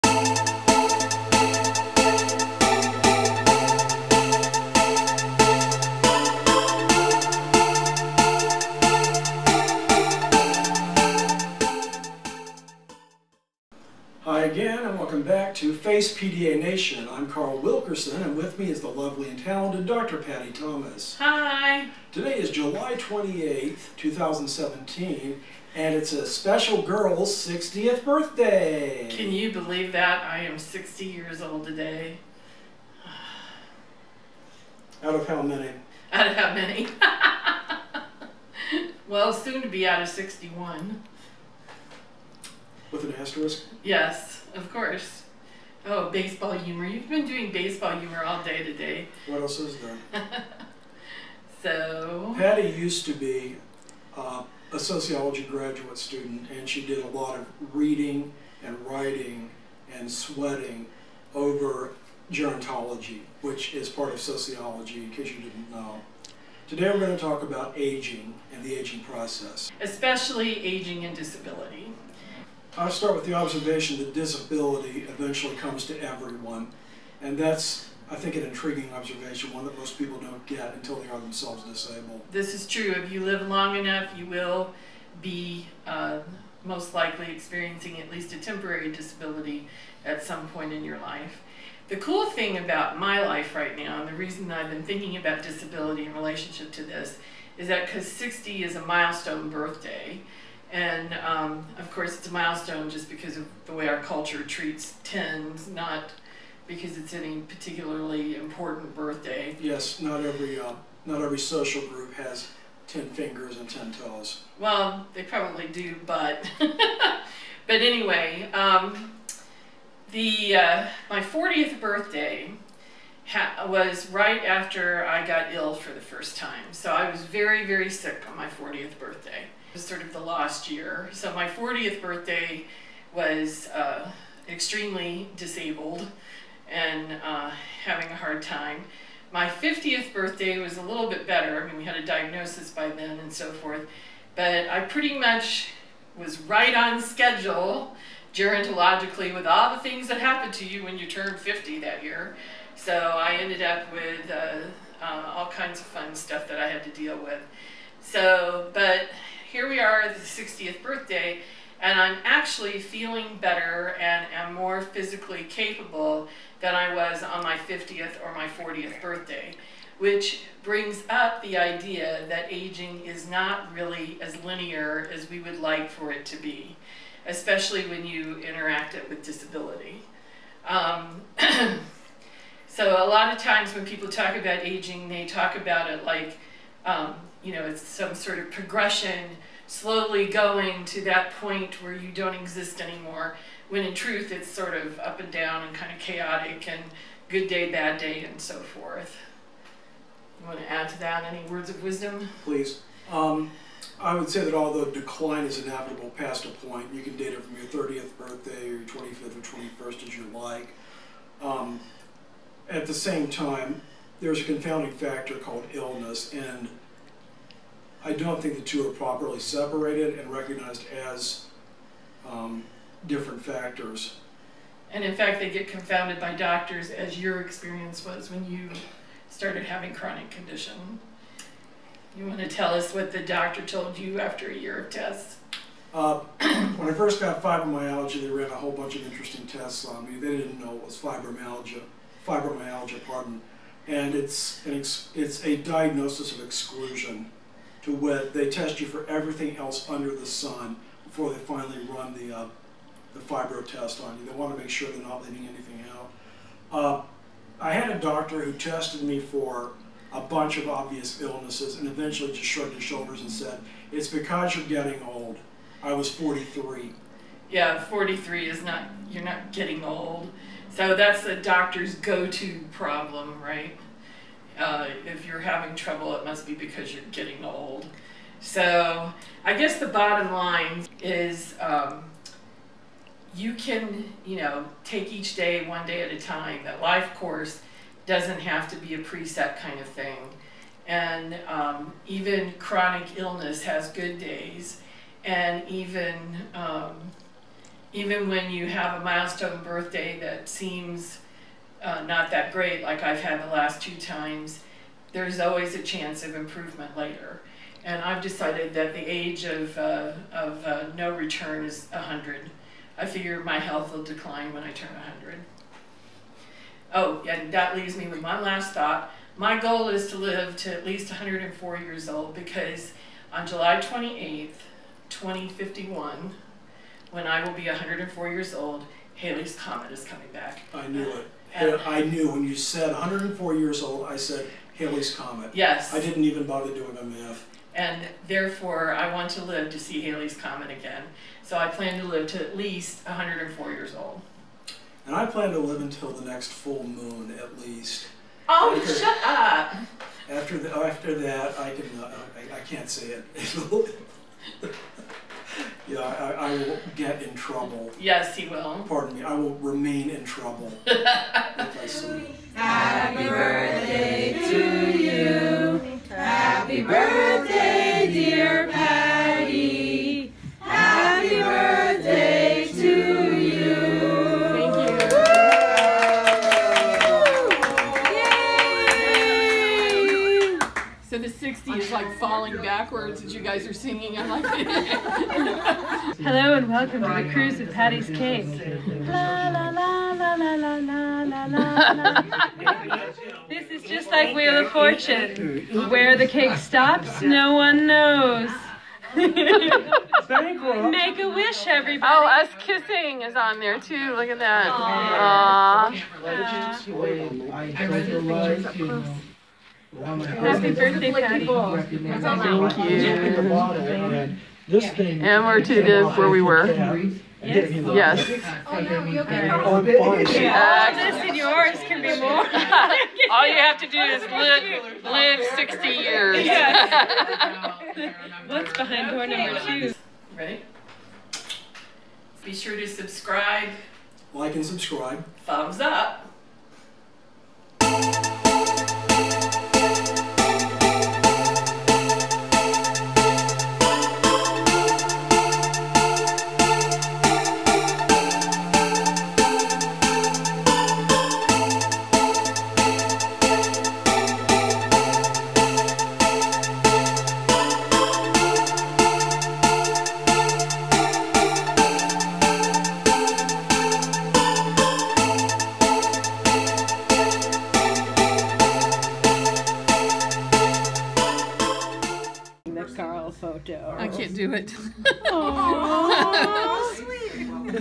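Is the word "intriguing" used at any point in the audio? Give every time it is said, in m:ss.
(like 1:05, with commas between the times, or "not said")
1:18.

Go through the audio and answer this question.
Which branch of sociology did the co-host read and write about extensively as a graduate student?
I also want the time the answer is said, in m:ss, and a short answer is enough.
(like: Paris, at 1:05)
Gerontology, at 1:02.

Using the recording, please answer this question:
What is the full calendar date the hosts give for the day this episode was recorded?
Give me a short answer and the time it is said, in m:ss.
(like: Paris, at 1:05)
July 28, 2017, at 0:22.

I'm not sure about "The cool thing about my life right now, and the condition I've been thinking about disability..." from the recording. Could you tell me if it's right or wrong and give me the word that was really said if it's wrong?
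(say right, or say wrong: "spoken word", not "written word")
wrong: "reason", not "condition".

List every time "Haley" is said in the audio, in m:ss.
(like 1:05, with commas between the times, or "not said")
5:29, 5:34, 5:40.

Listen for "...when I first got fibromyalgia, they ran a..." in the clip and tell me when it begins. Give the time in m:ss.
3:56.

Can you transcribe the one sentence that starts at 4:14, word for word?
They want to make sure they're not leaving anything out.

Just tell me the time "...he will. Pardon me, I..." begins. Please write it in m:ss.
5:58.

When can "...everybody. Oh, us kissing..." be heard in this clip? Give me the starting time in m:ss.
6:41.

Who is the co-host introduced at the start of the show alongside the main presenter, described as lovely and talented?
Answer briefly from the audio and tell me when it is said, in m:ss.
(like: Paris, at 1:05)
Dr. 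Pattie Thomas, at 0:19.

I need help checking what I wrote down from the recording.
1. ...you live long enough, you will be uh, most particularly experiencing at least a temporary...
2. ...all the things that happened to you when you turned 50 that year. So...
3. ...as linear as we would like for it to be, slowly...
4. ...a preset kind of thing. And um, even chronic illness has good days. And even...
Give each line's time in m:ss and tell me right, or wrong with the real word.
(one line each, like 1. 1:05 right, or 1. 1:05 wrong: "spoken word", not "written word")
1. 1:23 wrong: "likely", not "particularly"
2. 2:29 right
3. 2:54 wrong: "especially", not "slowly"
4. 4:48 right.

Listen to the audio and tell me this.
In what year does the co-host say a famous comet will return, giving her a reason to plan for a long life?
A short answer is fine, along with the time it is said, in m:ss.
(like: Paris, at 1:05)
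2051, at 5:25.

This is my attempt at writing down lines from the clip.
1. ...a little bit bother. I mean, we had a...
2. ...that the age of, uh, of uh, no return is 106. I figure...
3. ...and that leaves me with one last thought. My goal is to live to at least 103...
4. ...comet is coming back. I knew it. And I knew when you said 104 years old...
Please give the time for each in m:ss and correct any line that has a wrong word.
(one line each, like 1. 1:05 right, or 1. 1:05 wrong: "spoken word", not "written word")
1. 2:20 wrong: "better", not "bother"
2. 5:08 wrong: "100", not "106"
3. 5:17 wrong: "104", not "103"
4. 5:29 right.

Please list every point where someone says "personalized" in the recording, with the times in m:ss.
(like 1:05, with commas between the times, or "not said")
not said.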